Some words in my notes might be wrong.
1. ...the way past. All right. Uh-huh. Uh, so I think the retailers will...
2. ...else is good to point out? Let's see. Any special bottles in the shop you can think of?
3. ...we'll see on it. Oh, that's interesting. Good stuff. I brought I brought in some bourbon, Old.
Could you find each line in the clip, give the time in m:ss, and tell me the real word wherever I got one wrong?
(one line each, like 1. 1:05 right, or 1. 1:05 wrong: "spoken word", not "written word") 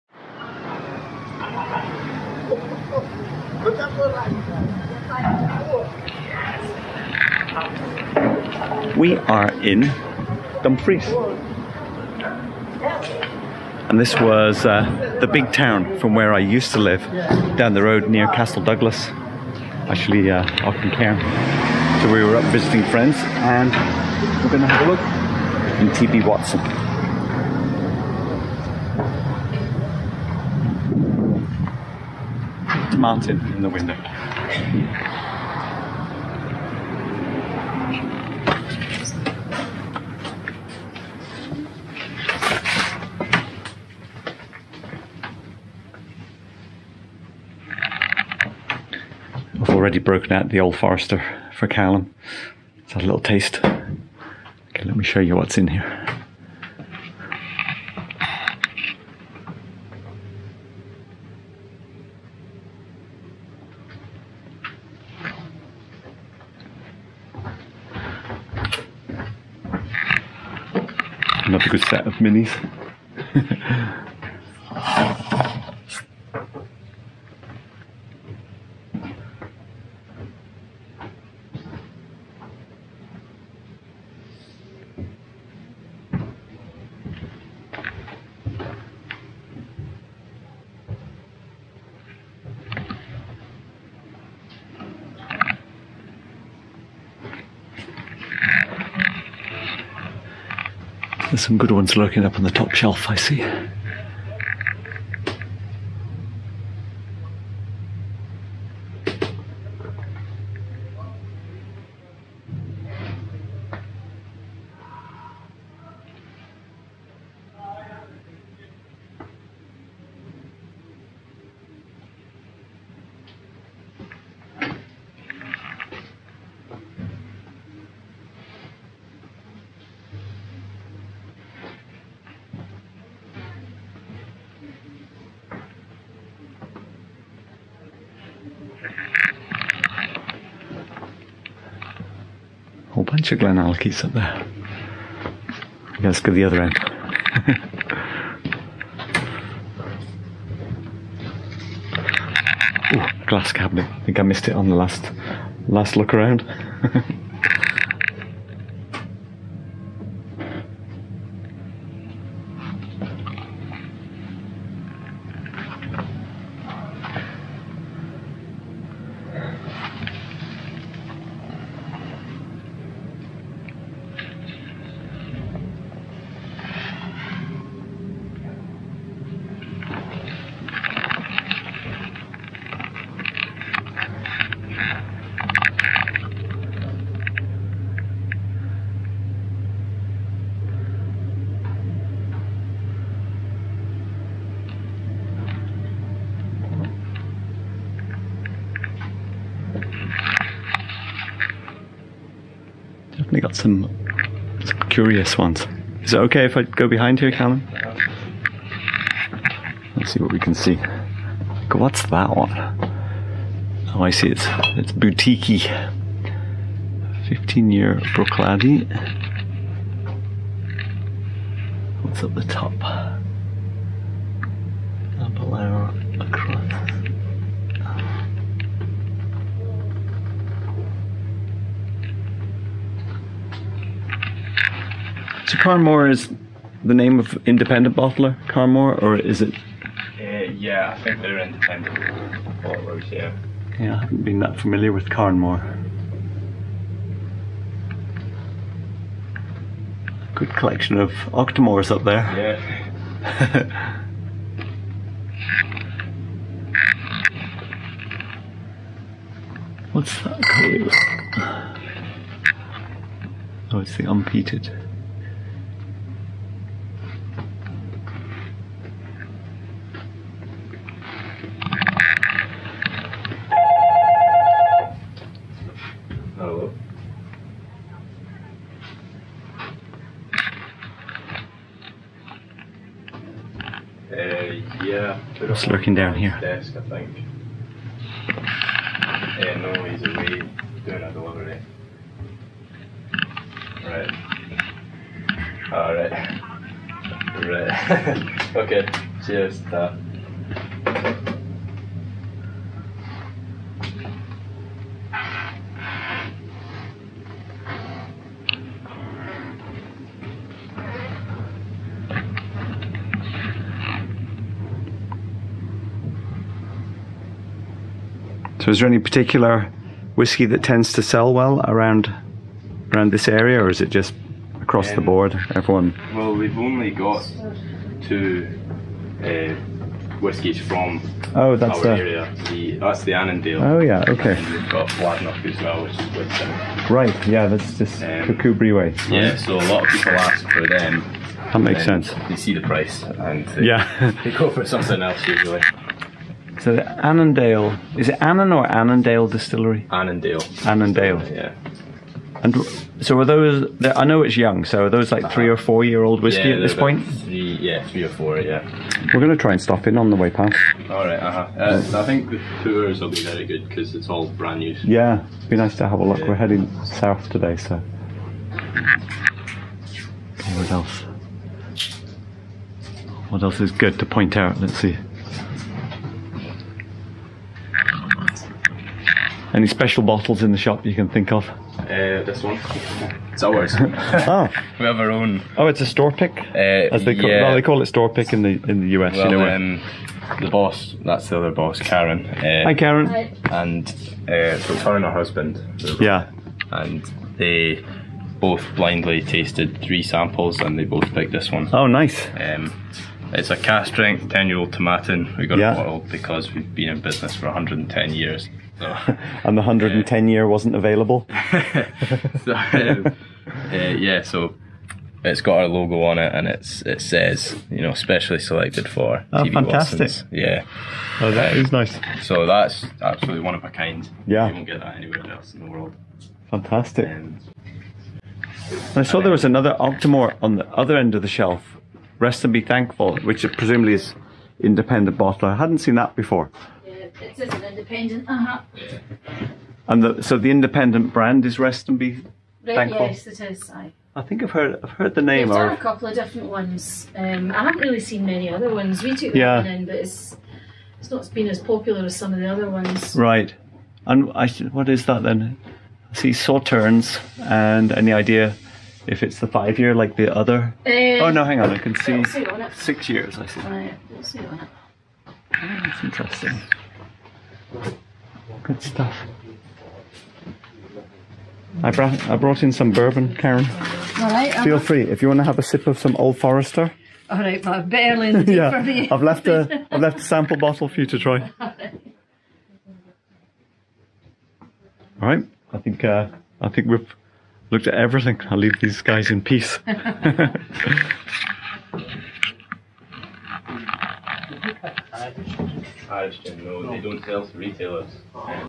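1. 6:00 wrong: "tours", not "retailers"
2. 6:13 right
3. 7:44 wrong: "Karen", not "Old".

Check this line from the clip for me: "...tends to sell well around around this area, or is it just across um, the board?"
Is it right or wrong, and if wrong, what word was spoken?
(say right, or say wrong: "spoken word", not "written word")
right.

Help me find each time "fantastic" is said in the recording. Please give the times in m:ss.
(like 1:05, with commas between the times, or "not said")
6:59, 7:06.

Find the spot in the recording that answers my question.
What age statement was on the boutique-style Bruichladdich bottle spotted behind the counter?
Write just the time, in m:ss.
3:37.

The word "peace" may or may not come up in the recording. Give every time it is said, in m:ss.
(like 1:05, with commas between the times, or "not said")
8:09.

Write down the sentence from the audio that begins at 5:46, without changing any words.
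So the Annandale, is it Annan or Annandale Distillery?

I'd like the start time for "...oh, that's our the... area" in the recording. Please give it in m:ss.
5:31.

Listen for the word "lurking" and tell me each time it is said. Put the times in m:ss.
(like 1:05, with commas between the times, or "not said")
1:41, 4:45.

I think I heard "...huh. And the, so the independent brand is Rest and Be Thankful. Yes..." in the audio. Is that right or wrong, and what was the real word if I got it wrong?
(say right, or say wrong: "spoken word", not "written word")
right.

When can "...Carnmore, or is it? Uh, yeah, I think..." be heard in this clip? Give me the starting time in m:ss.
3:58.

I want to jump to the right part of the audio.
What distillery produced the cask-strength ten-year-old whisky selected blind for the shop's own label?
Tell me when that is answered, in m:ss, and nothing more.
6:44.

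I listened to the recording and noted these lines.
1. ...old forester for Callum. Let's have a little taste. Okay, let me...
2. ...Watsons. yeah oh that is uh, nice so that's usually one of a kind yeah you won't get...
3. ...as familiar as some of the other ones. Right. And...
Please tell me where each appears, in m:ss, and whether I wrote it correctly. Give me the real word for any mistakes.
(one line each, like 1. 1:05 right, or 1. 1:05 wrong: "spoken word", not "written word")
1. 0:50 right
2. 6:59 wrong: "absolutely", not "usually"
3. 7:31 wrong: "popular", not "familiar".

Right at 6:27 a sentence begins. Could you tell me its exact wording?
well, they call it store pick in the in the US.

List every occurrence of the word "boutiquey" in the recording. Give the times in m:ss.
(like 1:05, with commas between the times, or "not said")
3:34.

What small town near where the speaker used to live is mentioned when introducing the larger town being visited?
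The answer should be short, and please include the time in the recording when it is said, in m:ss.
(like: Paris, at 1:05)
Castle Douglas, at 0:18.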